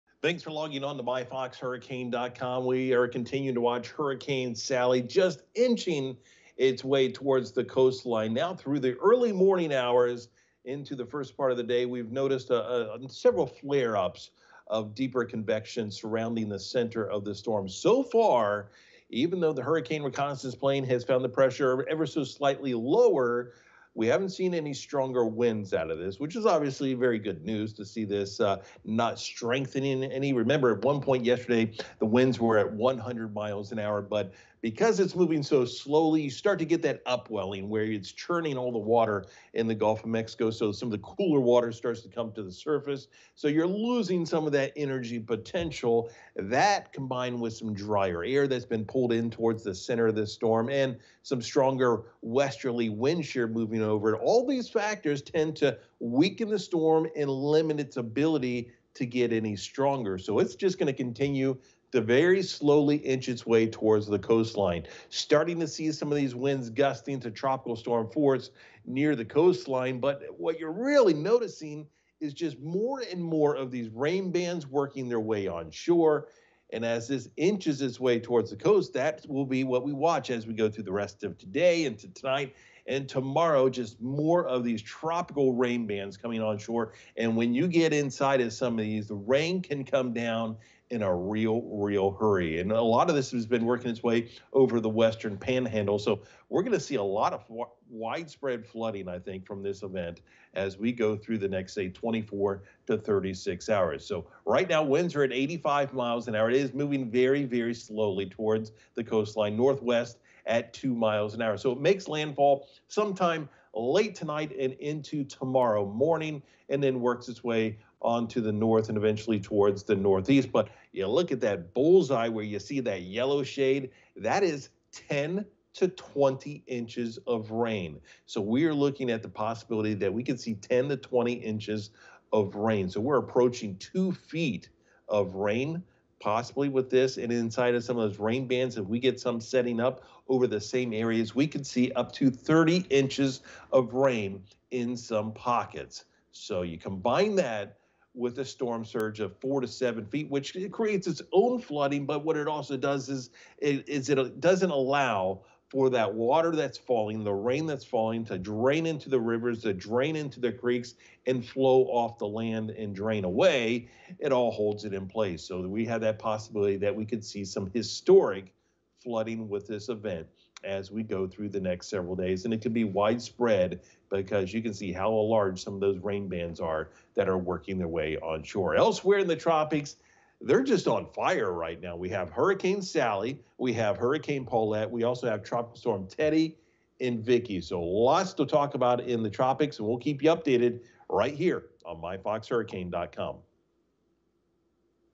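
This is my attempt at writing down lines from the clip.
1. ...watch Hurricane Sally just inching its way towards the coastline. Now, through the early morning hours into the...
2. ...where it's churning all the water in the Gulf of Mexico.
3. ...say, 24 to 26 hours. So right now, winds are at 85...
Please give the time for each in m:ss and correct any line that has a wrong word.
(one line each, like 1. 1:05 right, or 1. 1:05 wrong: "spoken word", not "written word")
1. 0:03 right
2. 0:37 right
3. 1:41 wrong: "36", not "26".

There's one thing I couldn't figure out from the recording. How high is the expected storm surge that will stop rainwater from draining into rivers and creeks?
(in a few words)
4 to 7 feet.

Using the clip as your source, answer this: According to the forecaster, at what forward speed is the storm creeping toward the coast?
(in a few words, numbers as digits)
2 mph.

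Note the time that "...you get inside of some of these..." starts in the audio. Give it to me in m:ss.
1:27.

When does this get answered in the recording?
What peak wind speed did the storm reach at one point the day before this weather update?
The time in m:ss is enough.
0:32.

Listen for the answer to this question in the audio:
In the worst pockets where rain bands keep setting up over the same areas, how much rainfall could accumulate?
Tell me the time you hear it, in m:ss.
2:22.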